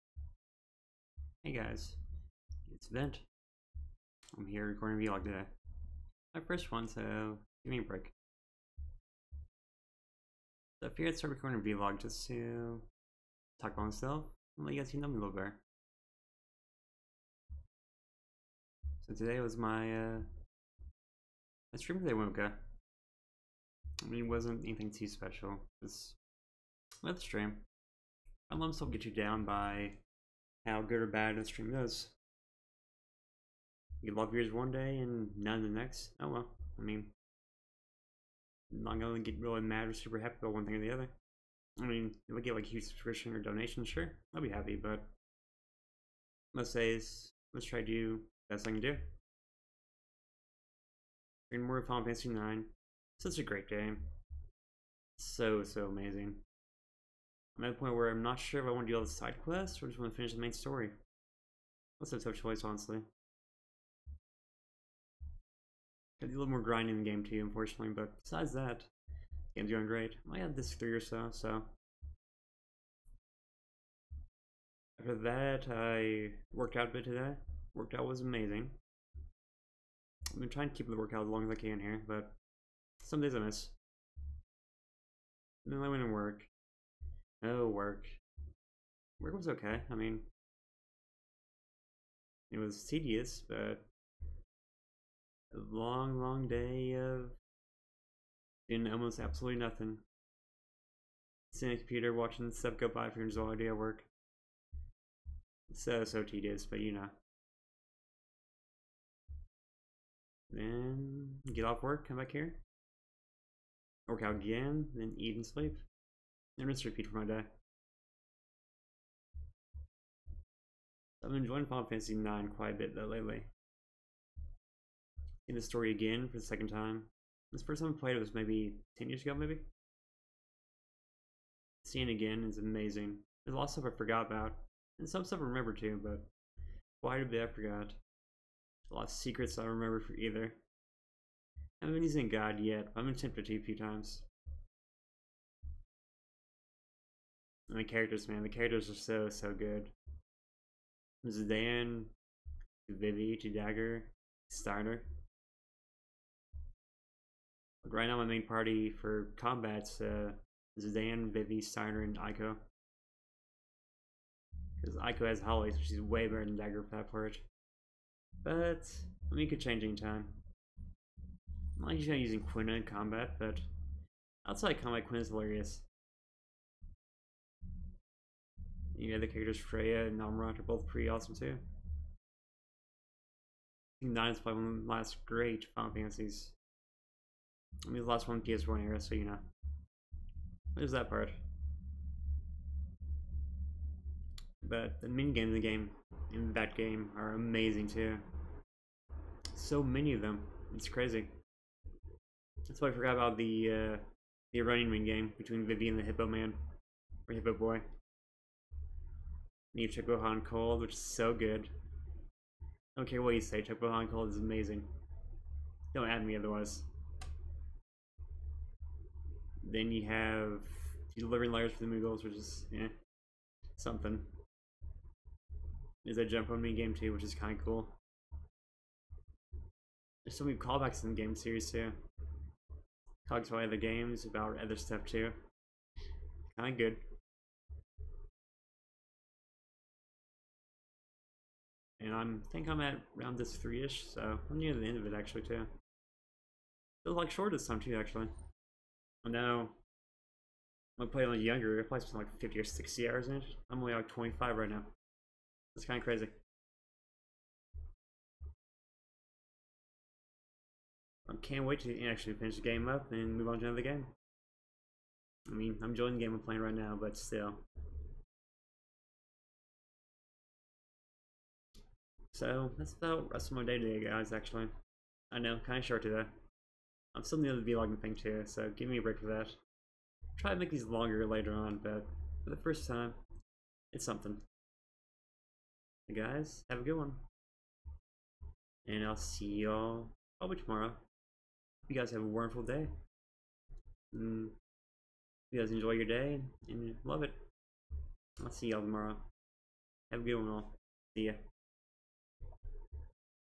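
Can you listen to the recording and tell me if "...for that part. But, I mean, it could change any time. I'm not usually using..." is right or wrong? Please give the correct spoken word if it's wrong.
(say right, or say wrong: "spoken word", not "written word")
right.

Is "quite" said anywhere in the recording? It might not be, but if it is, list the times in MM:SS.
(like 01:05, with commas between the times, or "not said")
02:02, 02:17.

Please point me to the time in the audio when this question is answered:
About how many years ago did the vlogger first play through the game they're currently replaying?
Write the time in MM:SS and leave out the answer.
02:08.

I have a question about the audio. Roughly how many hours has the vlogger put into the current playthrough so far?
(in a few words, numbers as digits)
25.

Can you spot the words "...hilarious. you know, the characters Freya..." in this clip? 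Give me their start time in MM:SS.
02:55.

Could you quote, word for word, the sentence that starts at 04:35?
I know, kind of short today.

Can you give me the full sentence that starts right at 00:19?
So today was my uh, my stream today went okay.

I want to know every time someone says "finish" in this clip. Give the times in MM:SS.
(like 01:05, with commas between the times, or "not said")
01:00, 04:22.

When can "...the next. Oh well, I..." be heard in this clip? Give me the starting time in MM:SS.
00:35.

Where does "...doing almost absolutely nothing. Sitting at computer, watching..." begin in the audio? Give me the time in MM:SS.
01:38.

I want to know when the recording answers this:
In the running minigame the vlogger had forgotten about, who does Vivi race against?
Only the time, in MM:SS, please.
03:26.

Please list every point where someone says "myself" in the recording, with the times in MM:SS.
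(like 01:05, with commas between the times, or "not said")
00:13, 00:28.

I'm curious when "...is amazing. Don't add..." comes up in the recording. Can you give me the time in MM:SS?
03:34.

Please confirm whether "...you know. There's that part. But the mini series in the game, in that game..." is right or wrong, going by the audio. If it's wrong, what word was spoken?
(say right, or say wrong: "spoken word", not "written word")
wrong: "games", not "series".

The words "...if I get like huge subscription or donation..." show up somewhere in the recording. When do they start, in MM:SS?
00:42.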